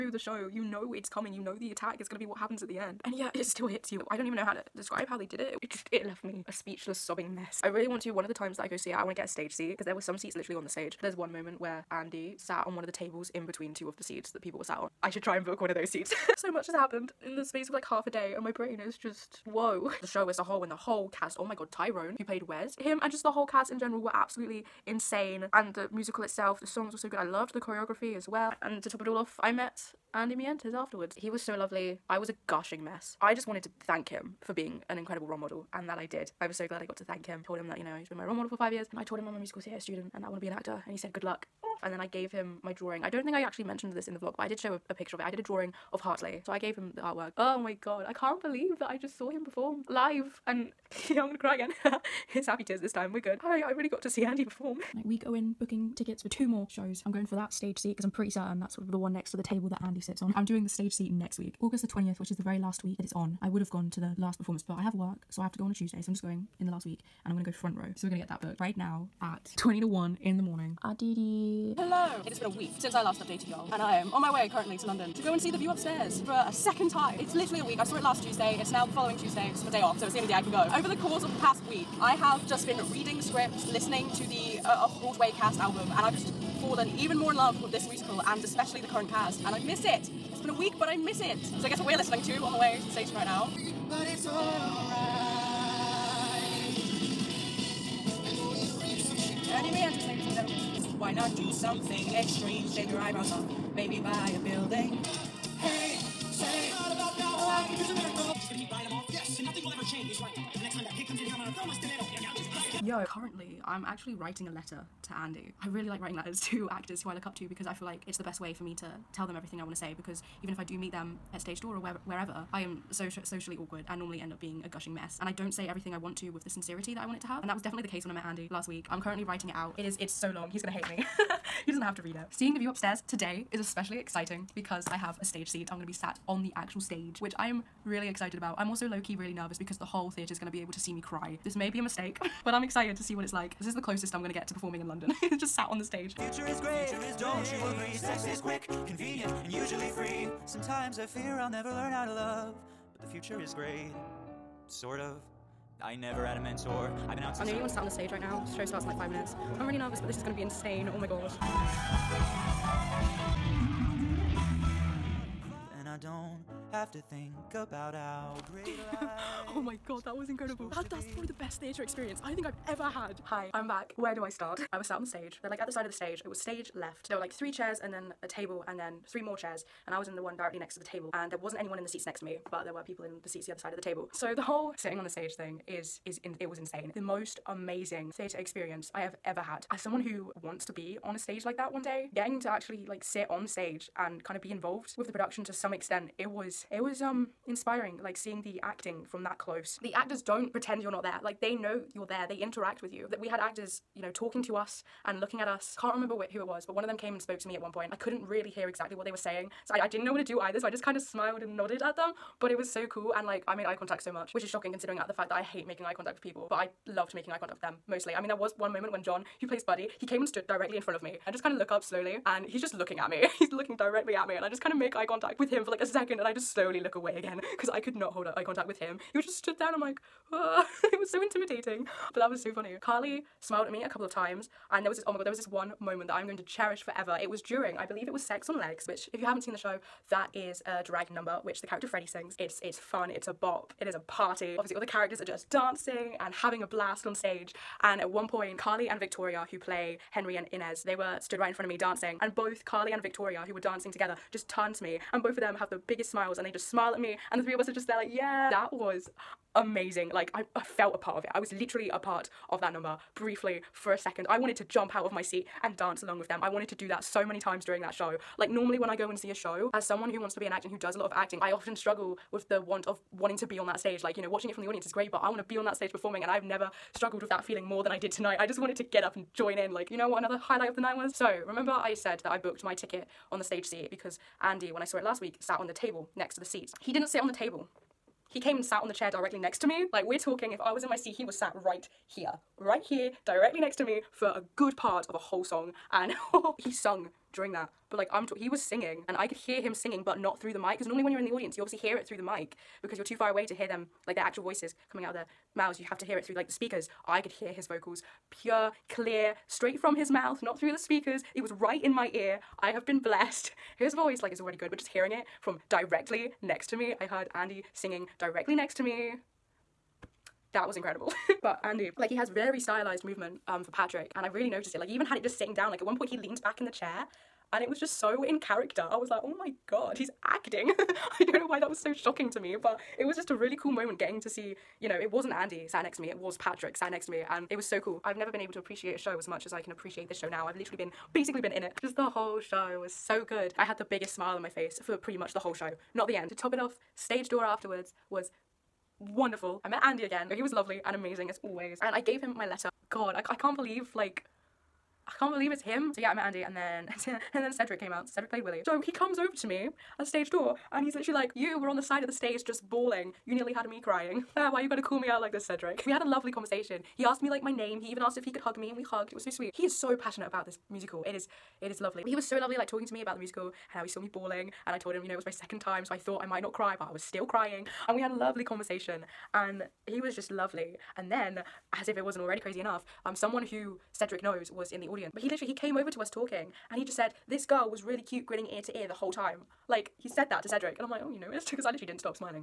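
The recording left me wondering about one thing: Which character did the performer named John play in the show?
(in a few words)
Buddy.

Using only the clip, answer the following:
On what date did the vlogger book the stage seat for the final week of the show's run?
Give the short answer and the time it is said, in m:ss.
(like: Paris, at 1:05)
August 20, at 1:01.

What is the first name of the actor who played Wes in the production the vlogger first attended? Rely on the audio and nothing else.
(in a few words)
Tyrone.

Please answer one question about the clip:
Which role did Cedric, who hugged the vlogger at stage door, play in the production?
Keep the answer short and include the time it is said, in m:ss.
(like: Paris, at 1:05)
Willie, at 5:58.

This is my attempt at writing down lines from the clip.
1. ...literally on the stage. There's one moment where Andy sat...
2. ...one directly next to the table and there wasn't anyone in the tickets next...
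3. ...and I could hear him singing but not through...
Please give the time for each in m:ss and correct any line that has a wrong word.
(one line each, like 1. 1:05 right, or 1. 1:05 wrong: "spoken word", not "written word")
1. 0:10 right
2. 3:00 wrong: "seats", not "tickets"
3. 4:59 right.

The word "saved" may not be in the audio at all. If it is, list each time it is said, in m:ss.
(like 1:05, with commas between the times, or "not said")
not said.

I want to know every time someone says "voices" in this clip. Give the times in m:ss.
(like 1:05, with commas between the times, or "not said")
5:04, 5:13.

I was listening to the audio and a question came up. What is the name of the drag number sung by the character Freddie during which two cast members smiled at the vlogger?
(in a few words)
Sex on Legs.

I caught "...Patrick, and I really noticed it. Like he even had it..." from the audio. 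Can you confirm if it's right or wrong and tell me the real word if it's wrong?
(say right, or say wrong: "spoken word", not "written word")
right.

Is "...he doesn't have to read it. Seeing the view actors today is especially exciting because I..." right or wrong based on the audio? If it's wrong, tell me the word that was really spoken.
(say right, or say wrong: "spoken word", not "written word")
wrong: "upstairs", not "actors".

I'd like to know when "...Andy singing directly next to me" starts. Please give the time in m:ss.
5:17.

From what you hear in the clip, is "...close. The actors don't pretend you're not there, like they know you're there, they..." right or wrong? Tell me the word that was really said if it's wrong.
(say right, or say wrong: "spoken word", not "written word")
right.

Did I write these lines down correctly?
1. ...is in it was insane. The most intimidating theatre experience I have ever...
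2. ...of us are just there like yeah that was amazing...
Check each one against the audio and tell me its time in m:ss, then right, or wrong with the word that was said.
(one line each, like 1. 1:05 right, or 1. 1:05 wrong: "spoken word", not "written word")
1. 3:06 wrong: "amazing", not "intimidating"
2. 4:17 right.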